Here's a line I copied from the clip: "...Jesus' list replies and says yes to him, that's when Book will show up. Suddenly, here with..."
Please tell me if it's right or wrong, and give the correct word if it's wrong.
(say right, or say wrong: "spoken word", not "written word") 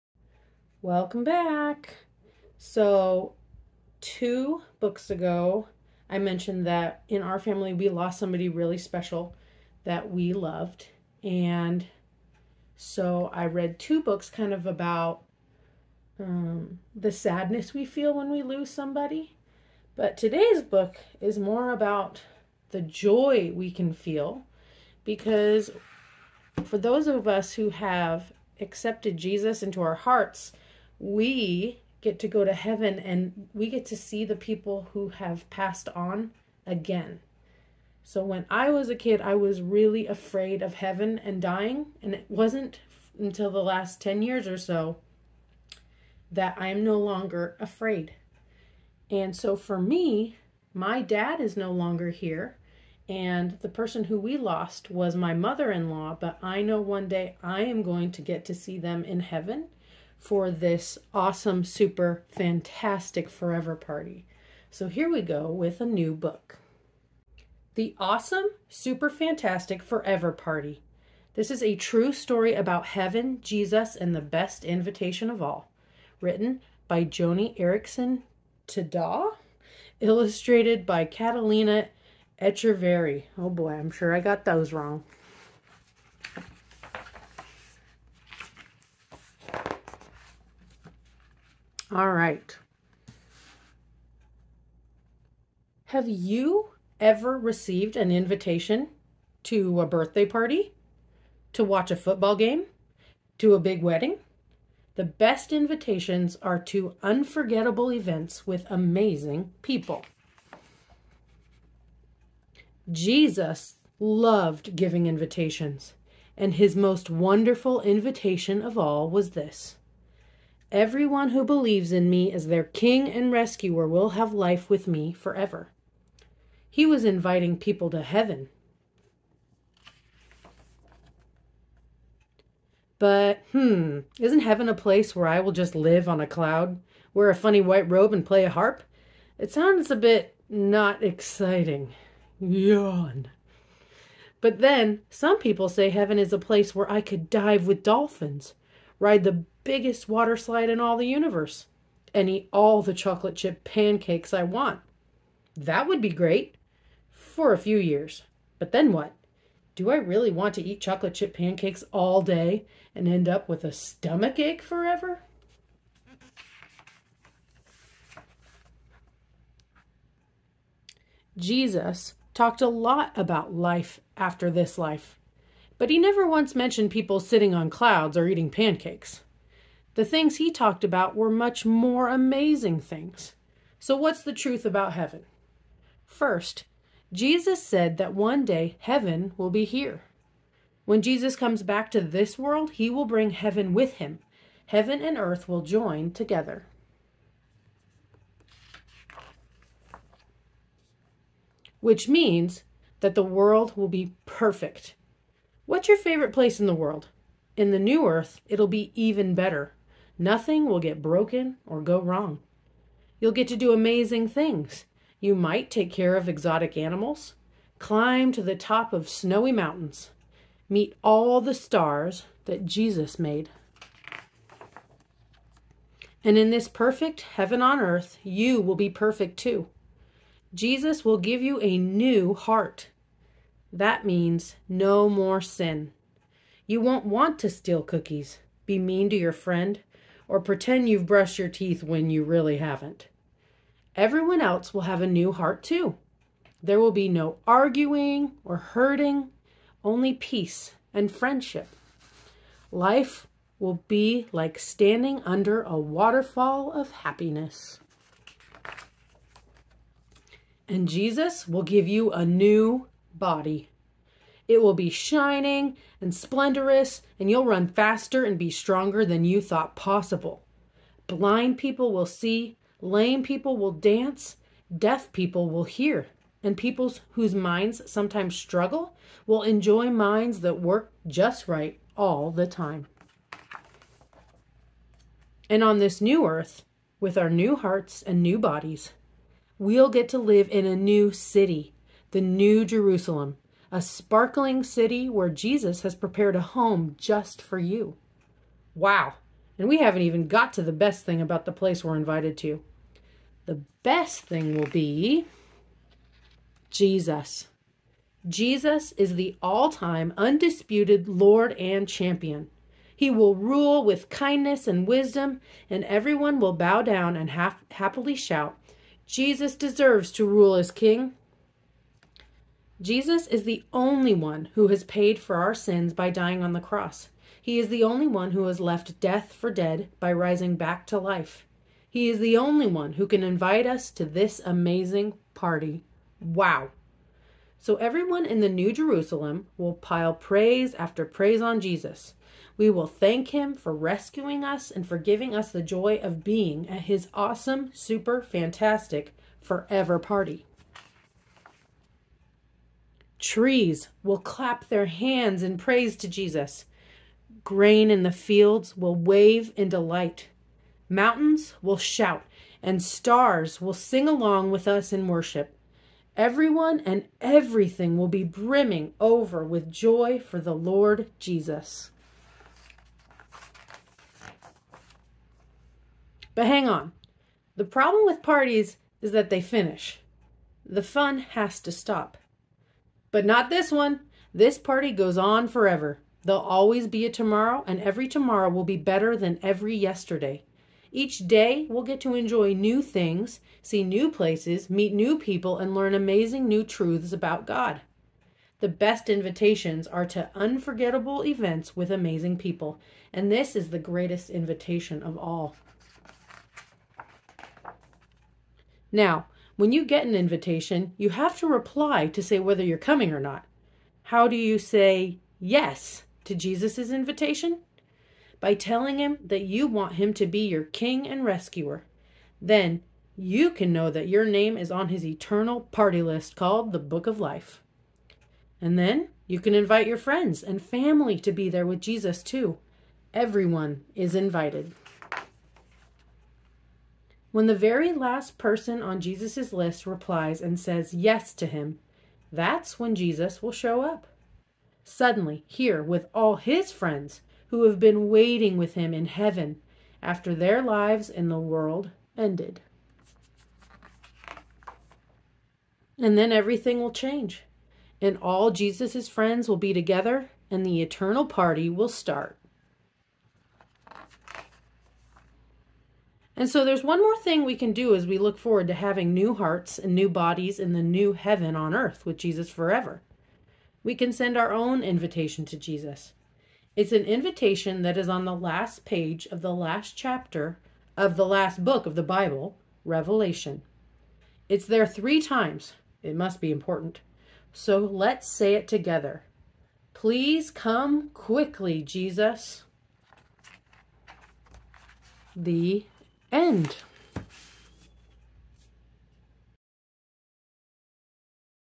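wrong: "Jesus", not "Book".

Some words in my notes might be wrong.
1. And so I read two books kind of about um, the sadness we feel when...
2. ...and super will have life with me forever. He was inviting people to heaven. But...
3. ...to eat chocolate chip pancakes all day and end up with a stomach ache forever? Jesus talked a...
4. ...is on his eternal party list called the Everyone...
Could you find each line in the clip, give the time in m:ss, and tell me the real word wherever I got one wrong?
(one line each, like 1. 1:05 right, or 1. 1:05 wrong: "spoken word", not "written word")
1. 0:11 right
2. 2:03 wrong: "rescuer", not "super"
3. 2:40 right
4. 7:04 wrong: "Book", not "Everyone".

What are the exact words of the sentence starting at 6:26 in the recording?
There'll always be a tomorrow, and every tomorrow will be better than every yesterday.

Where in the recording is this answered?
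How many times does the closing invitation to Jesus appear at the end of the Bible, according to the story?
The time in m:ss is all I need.
8:04.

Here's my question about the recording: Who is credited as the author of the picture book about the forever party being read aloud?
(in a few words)
Joni Eareckson Tada.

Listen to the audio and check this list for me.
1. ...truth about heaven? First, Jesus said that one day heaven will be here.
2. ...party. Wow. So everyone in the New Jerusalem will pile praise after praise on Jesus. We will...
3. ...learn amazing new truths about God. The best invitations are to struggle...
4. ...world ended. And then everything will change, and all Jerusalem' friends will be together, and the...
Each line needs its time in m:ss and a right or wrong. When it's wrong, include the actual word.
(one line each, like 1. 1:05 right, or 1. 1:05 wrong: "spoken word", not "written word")
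1. 3:04 right
2. 5:35 right
3. 6:35 wrong: "unforgettable", not "struggle"
4. 7:31 wrong: "Jesus", not "Jerusalem".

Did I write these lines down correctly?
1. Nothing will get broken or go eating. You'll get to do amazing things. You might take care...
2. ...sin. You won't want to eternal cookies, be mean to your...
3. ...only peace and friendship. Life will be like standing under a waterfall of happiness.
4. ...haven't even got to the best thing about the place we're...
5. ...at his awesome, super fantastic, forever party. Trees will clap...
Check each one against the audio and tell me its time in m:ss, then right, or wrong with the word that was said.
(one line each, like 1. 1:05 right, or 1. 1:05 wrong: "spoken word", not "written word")
1. 3:30 wrong: "wrong", not "eating"
2. 3:55 wrong: "steal", not "eternal"
3. 4:09 right
4. 4:59 right
5. 5:46 right.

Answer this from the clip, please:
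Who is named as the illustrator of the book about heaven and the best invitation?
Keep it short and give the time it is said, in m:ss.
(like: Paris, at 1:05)
Catalina Echeverri, at 1:21.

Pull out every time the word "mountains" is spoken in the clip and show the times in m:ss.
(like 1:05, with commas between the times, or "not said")
3:39, 6:00.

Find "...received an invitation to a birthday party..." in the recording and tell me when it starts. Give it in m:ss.
1:37.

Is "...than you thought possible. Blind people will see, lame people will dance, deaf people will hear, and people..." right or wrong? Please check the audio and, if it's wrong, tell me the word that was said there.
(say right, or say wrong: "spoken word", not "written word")
right.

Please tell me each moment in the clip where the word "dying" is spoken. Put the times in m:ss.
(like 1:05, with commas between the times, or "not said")
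0:41, 5:26.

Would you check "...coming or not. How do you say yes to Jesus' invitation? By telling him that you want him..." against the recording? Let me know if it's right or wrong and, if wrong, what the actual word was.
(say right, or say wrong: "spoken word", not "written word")
right.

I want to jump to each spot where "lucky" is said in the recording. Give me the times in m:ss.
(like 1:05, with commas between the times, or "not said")
not said.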